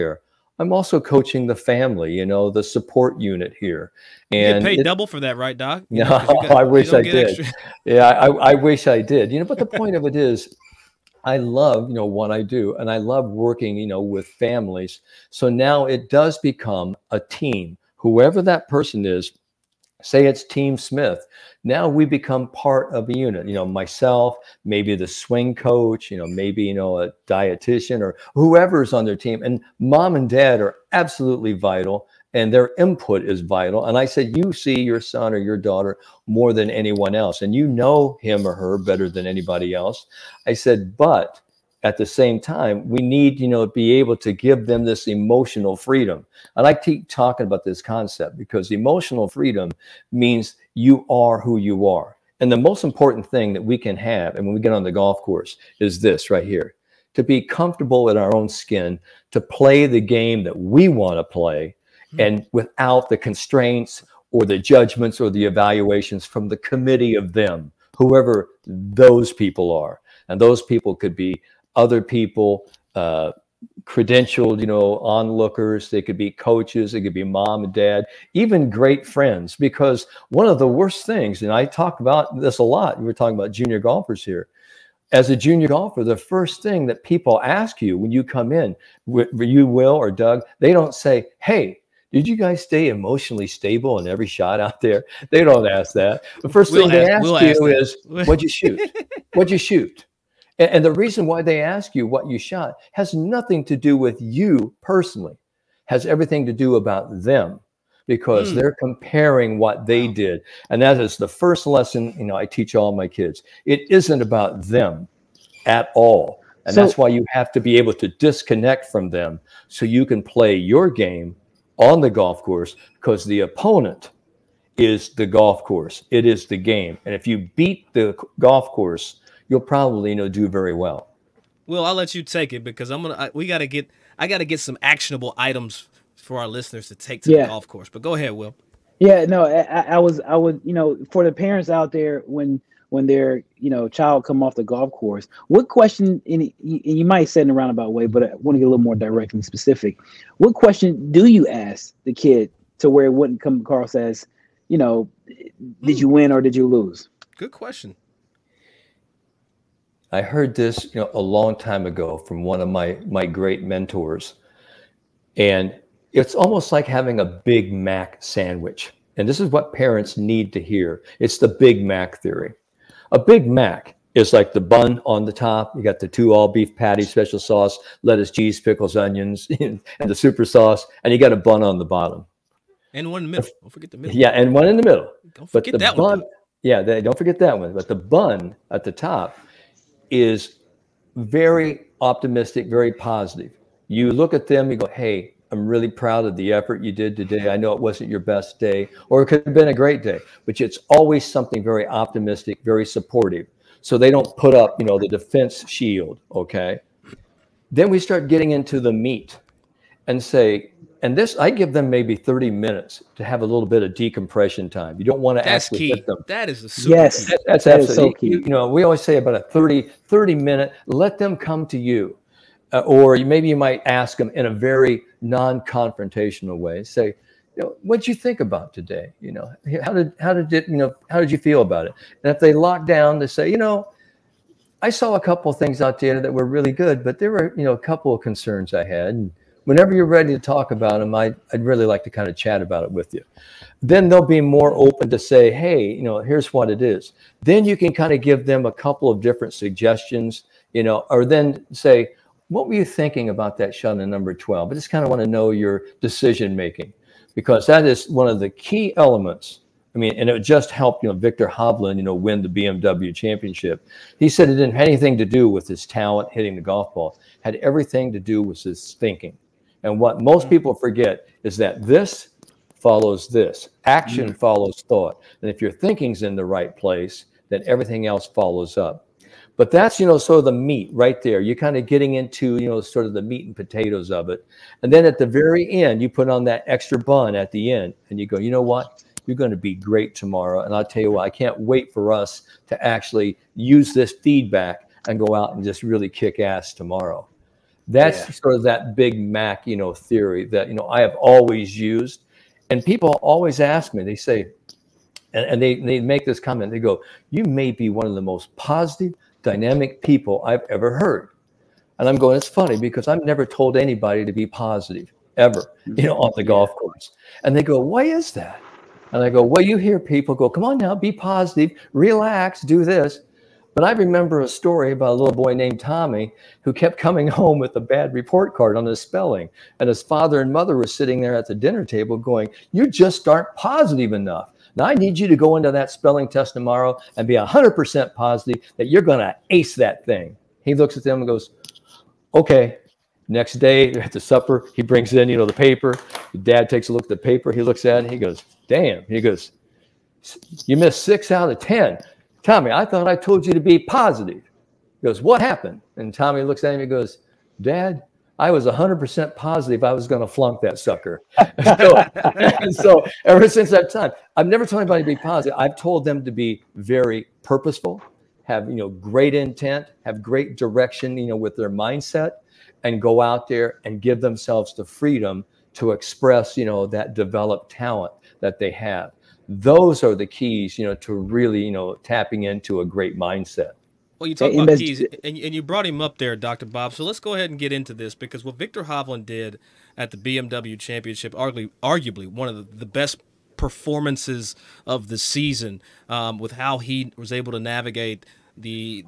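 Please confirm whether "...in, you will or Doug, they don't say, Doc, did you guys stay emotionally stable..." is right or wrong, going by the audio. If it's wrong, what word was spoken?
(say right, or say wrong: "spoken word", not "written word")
wrong: "Hey", not "Doc".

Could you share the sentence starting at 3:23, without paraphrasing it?
So they don't put up, you know, the defense shield.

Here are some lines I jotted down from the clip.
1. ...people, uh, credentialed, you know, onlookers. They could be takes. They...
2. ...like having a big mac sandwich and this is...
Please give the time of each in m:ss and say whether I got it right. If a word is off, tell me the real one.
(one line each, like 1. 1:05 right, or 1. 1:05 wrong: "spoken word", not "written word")
1. 1:12 wrong: "coaches", not "takes"
2. 2:46 right.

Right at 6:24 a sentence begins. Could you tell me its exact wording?
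Well, you talk about keys, and, and you brought him up there, Dr.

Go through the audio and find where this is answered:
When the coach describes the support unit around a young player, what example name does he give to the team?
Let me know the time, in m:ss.
0:20.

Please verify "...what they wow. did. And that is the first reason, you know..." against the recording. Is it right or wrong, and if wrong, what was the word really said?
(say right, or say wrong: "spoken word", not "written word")
wrong: "lesson", not "reason".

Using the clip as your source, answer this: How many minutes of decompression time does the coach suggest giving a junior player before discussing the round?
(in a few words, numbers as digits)
30.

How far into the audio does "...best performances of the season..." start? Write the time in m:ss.
6:32.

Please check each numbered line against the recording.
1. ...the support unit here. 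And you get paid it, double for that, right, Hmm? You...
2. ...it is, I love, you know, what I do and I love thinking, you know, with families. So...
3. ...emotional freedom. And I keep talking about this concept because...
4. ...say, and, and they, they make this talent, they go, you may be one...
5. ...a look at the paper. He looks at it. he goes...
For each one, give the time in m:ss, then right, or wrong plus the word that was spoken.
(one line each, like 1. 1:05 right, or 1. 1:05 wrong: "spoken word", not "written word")
1. 0:02 wrong: "Doc", not "Hmm"
2. 0:10 wrong: "working", not "thinking"
3. 0:45 right
4. 5:04 wrong: "comment", not "talent"
5. 5:46 right.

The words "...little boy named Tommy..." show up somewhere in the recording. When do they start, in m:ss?
5:25.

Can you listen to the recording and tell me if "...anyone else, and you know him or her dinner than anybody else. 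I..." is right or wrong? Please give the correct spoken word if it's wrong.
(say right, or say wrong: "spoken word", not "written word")
wrong: "better", not "dinner".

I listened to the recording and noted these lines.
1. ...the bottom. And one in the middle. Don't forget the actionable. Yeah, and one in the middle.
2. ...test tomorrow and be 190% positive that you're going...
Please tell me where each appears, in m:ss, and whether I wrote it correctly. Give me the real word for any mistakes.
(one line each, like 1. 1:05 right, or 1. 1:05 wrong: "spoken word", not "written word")
1. 3:01 wrong: "middle", not "actionable"
2. 5:36 wrong: "100", not "190".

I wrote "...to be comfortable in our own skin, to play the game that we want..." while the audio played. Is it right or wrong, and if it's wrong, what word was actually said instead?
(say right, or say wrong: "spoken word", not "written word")
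right.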